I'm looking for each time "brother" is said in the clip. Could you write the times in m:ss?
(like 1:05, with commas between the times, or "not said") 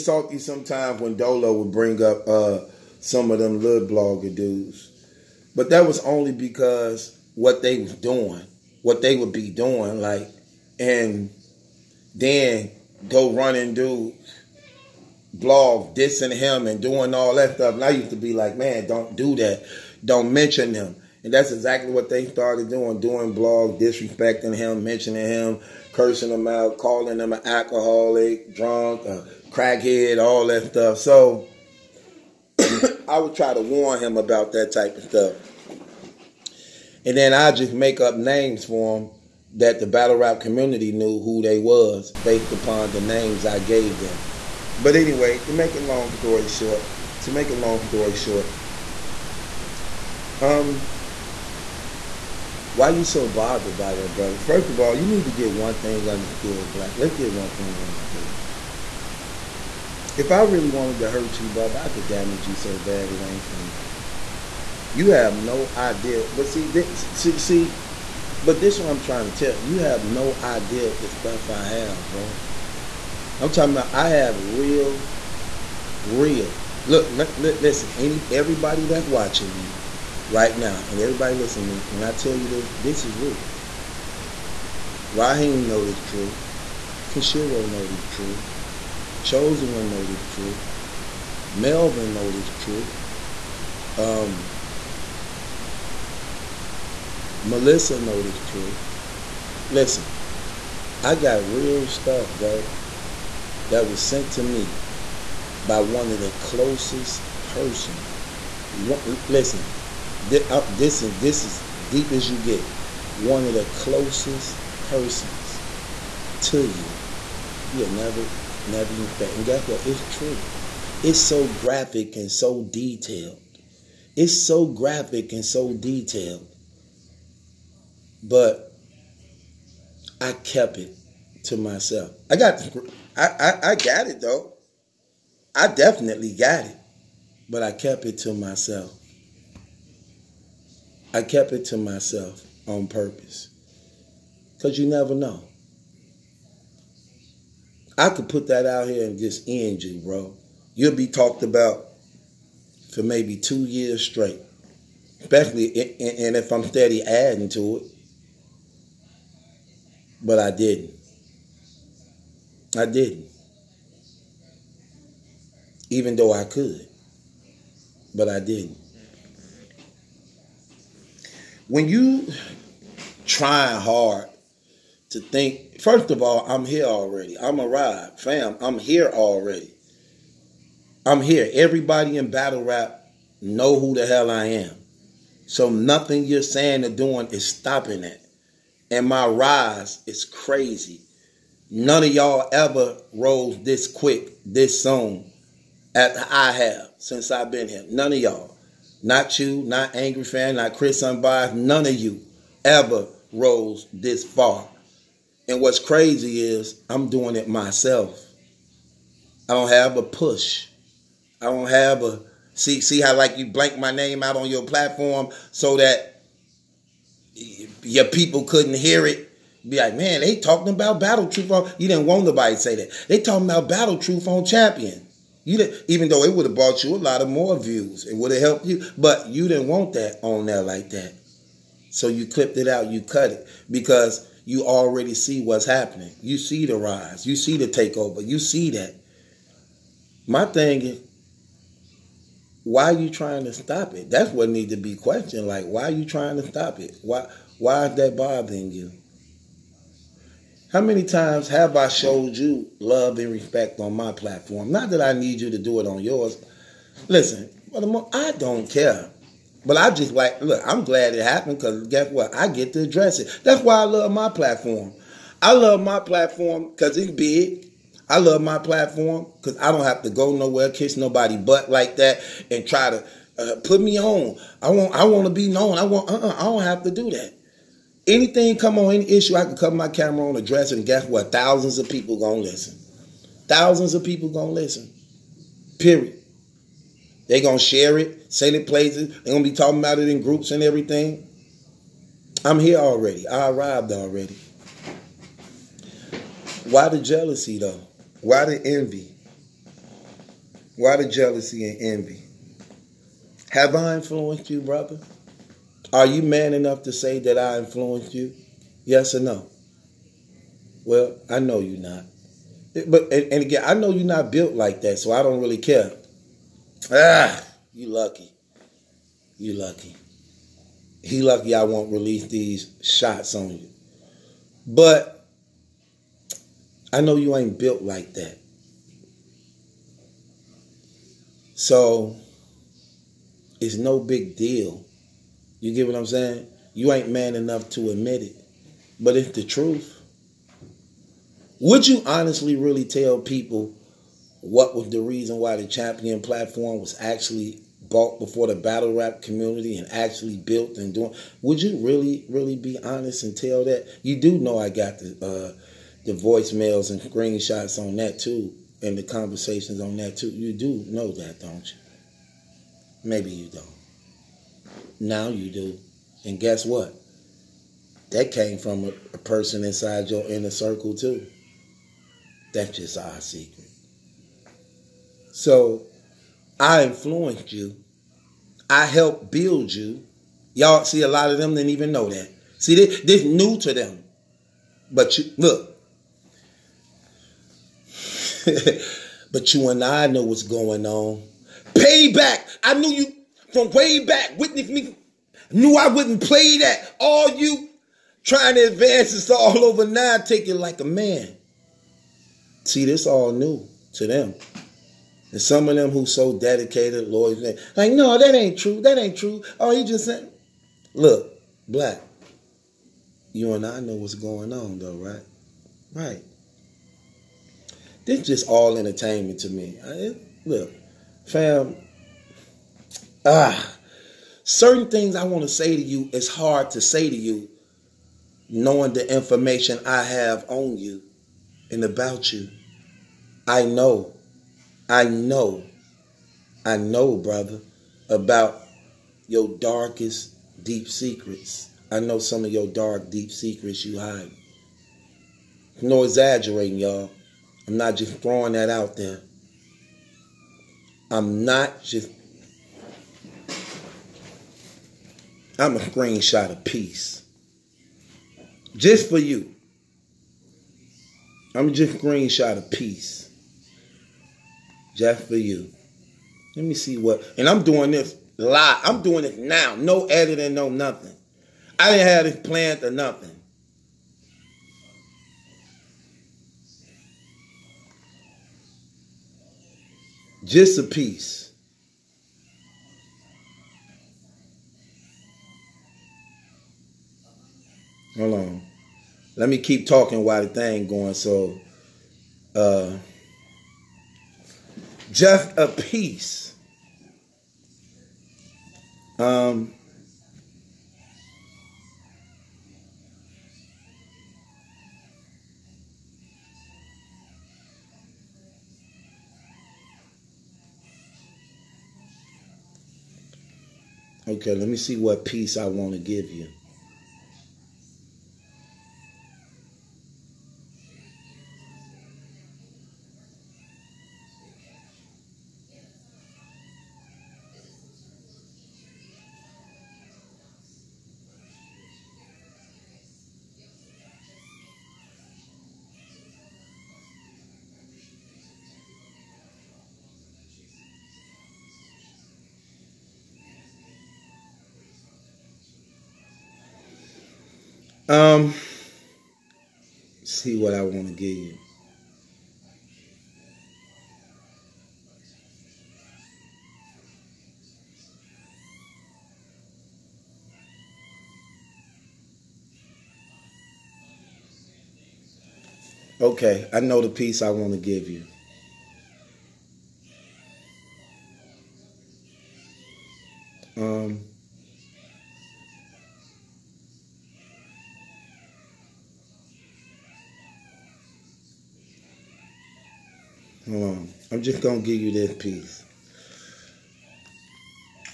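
0:54, 1:01, 5:04, 7:17.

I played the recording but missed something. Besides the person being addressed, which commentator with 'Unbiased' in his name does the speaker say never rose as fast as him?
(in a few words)
Chris Unbiased.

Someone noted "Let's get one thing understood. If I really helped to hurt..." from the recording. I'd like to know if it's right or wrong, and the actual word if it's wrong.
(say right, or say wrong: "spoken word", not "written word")
wrong: "wanted", not "helped".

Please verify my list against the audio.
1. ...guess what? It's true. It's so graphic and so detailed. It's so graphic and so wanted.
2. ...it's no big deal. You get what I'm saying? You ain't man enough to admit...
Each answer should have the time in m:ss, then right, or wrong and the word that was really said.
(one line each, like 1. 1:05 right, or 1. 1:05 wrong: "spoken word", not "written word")
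1. 1:59 wrong: "detailed", not "wanted"
2. 5:33 right.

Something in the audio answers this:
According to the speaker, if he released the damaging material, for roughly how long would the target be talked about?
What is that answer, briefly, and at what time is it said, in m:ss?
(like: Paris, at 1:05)
2 years, at 2:33.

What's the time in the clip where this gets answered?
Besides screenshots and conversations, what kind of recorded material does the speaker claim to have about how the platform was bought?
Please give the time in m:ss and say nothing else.
5:56.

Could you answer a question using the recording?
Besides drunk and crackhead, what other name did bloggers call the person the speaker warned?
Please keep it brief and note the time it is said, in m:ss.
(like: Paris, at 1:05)
alcoholic, at 0:27.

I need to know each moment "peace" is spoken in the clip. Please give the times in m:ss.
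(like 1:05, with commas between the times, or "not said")
7:36, 7:42.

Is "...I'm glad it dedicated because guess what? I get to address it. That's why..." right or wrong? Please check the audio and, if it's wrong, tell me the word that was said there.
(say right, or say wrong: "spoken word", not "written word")
wrong: "happened", not "dedicated".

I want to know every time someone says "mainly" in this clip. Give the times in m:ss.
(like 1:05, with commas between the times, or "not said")
not said.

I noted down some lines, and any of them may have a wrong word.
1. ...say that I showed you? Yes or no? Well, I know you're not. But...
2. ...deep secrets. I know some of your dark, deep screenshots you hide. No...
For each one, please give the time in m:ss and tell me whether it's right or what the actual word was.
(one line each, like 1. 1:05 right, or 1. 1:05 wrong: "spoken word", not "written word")
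1. 5:06 wrong: "influenced", not "showed"
2. 7:20 wrong: "secrets", not "screenshots".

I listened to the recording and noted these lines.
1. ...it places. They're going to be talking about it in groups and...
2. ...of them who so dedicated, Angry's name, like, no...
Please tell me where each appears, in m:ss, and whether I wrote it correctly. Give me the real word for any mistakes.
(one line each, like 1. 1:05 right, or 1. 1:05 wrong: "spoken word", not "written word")
1. 4:48 right
2. 6:45 wrong: "Lord", not "Angry".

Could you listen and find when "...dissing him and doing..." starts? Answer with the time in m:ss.
0:15.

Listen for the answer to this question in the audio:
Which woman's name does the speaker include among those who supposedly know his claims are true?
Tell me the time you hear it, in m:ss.
1:37.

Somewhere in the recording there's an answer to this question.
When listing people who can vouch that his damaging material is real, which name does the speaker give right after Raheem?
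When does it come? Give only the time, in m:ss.
1:27.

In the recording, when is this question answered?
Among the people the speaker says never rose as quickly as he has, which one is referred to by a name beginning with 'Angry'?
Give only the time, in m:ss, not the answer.
3:19.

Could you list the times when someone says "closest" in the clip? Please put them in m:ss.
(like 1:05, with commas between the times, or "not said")
1:46, 1:53.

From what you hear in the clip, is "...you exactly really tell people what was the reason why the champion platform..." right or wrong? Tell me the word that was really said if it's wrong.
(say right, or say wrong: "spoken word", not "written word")
wrong: "honestly", not "exactly".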